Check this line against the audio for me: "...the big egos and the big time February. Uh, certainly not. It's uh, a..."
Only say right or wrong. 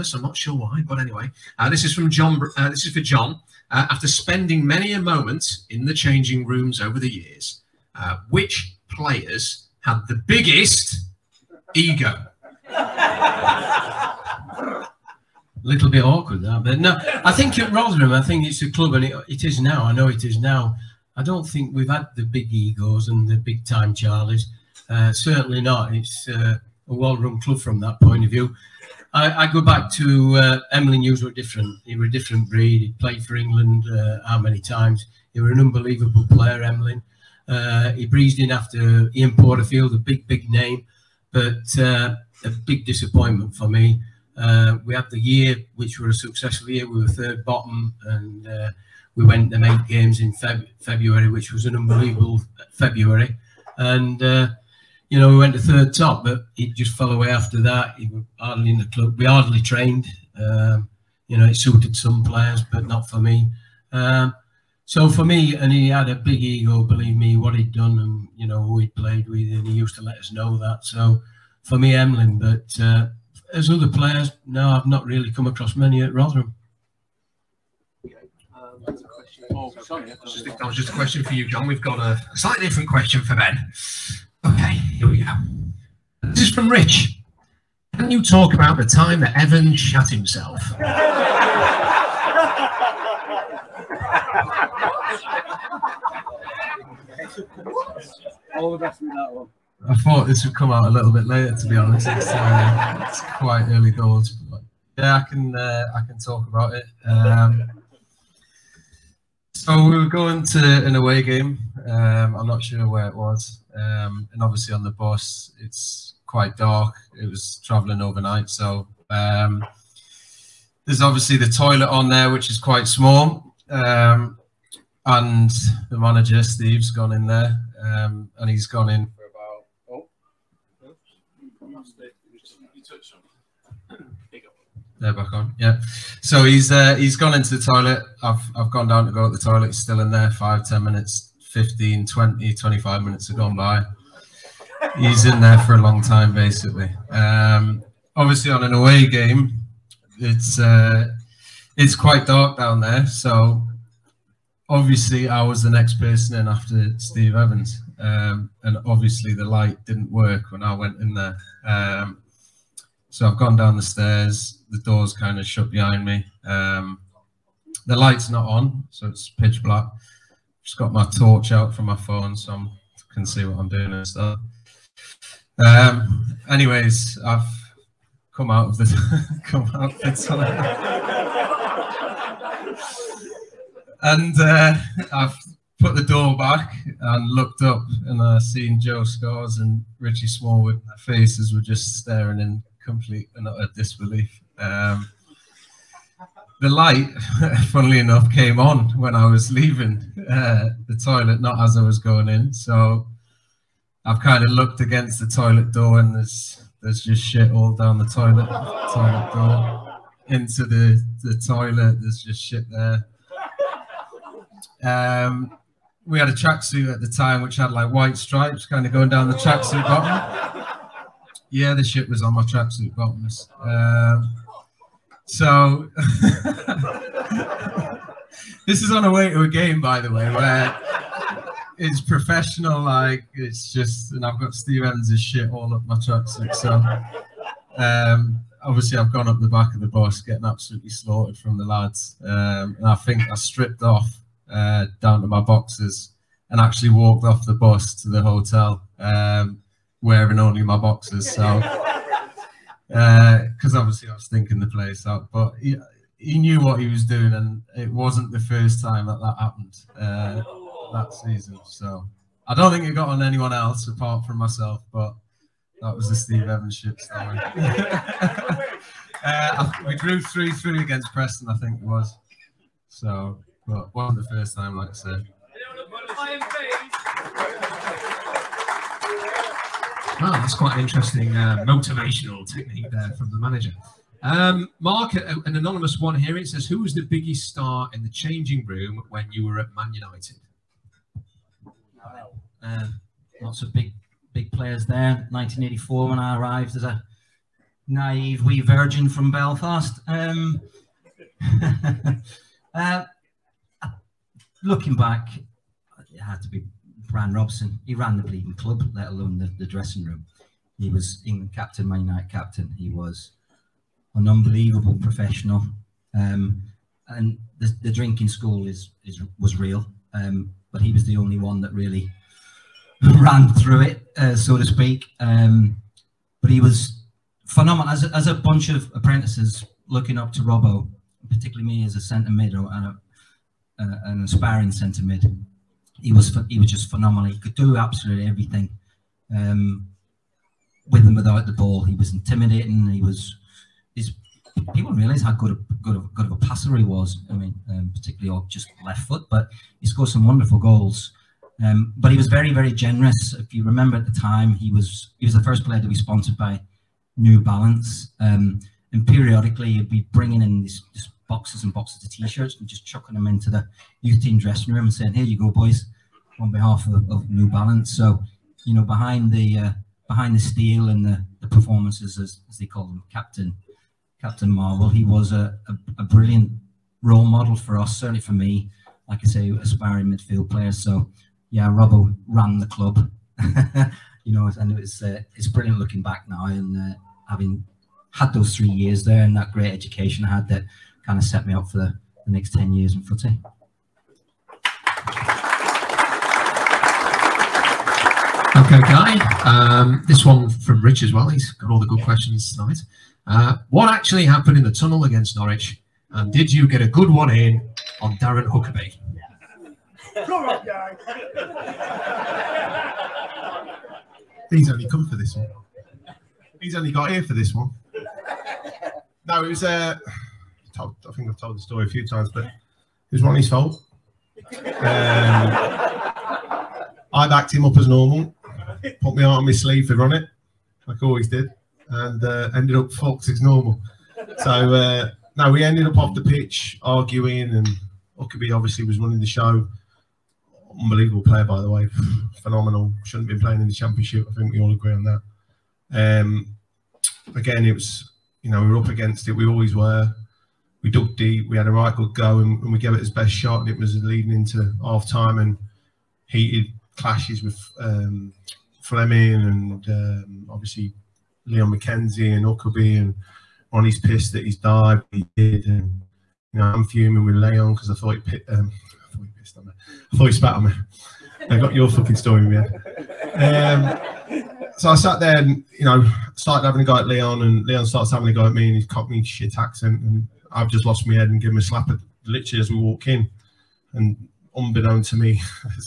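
wrong.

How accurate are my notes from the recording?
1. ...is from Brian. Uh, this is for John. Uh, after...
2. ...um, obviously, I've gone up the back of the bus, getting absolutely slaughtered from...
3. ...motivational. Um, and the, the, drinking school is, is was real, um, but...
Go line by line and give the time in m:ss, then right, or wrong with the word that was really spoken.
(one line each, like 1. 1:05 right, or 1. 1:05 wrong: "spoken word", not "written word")
1. 0:01 wrong: "John", not "Brian"
2. 3:57 right
3. 5:15 wrong: "professional", not "motivational".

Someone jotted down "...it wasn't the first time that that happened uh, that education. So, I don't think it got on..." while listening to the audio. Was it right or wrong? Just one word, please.
wrong.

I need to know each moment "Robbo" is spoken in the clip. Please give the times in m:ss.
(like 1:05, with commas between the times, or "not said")
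5:30, 6:21.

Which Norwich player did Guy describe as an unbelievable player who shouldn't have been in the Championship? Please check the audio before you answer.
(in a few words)
Darren Huckerby.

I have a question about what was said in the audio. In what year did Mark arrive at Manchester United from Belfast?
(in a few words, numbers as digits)
1984.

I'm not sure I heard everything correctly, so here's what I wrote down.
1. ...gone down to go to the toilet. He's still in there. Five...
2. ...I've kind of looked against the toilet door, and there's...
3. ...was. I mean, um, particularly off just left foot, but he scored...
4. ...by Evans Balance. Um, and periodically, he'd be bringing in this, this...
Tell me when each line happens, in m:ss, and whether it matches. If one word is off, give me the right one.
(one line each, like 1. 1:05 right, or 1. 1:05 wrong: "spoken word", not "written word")
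1. 2:18 right
2. 3:24 right
3. 5:46 right
4. 5:56 wrong: "New", not "Evans".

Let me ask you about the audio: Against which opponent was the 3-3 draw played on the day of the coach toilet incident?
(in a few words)
Preston.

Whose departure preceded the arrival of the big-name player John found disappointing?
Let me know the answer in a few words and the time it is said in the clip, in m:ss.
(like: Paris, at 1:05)
Ian Porterfield, at 0:39.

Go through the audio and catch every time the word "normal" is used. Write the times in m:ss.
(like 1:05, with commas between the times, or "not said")
7:07, 7:13.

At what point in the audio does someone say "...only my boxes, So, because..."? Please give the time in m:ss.
4:10.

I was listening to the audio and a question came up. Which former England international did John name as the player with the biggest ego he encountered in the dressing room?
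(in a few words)
Emlyn Hughes.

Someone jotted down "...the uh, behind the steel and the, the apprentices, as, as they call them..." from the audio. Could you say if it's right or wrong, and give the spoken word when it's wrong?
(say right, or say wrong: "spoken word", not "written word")
wrong: "performances", not "apprentices".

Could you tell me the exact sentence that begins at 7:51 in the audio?
I got your fucking story man.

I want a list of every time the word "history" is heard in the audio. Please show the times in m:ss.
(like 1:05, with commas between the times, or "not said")
not said.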